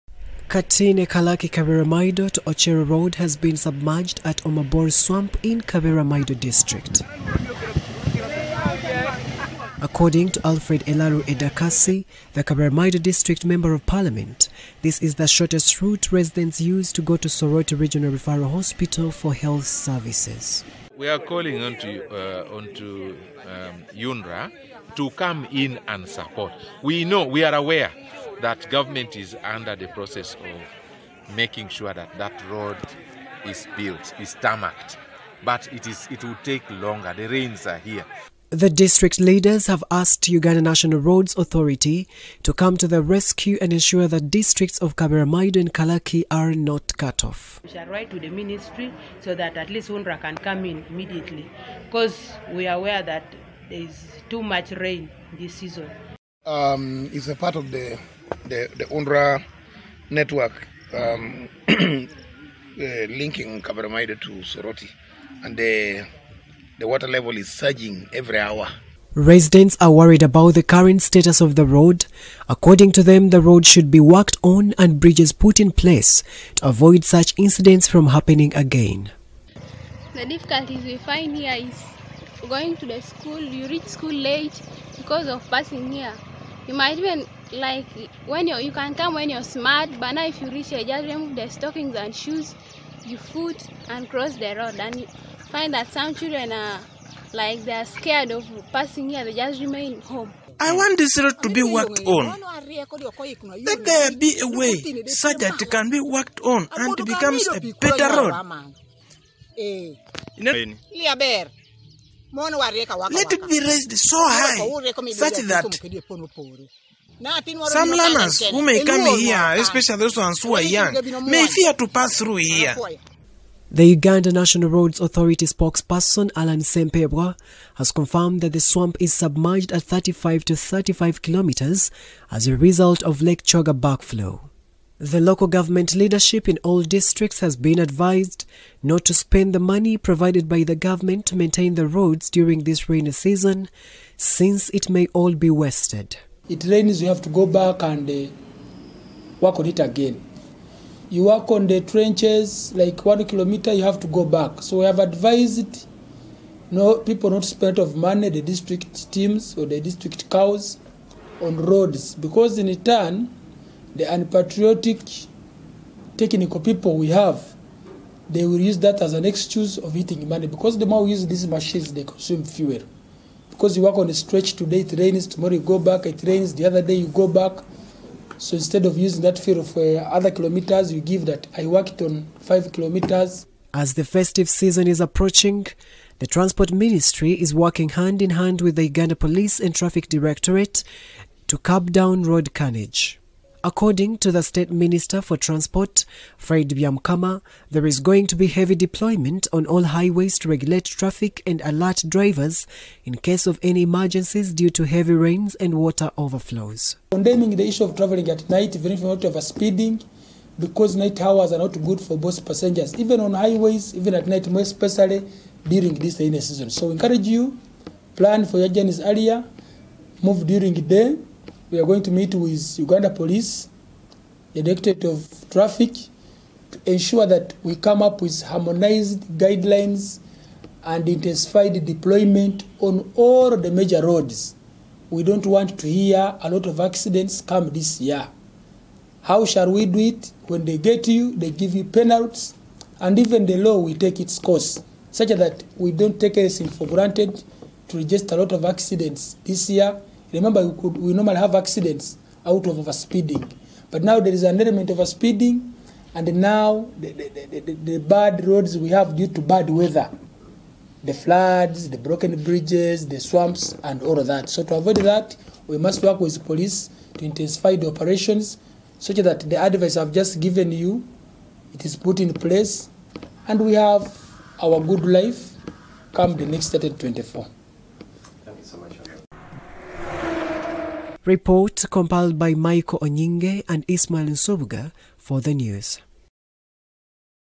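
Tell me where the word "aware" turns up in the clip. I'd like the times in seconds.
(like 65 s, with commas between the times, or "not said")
27 s, 52 s.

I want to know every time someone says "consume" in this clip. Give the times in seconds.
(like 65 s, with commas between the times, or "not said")
172 s.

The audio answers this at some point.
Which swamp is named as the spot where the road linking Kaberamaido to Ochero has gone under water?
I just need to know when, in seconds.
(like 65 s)
4 s.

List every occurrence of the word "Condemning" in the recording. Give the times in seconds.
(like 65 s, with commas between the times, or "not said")
207 s.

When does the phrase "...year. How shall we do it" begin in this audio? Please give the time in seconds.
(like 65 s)
238 s.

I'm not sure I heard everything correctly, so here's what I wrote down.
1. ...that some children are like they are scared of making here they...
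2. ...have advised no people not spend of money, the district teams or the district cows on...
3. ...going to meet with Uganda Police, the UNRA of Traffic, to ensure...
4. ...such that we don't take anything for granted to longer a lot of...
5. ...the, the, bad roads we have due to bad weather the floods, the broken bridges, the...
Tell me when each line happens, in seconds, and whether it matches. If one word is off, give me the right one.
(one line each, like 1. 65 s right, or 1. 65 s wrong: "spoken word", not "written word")
1. 95 s wrong: "passing", not "making"
2. 154 s right
3. 221 s wrong: "Directorate", not "UNRA"
4. 245 s wrong: "register", not "longer"
5. 257 s right.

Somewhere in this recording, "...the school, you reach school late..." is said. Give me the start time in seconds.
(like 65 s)
82 s.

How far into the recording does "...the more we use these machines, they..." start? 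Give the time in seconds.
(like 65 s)
170 s.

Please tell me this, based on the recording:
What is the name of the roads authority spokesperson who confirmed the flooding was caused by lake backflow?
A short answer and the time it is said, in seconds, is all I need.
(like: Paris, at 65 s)
Alan Sempebwa, at 126 s.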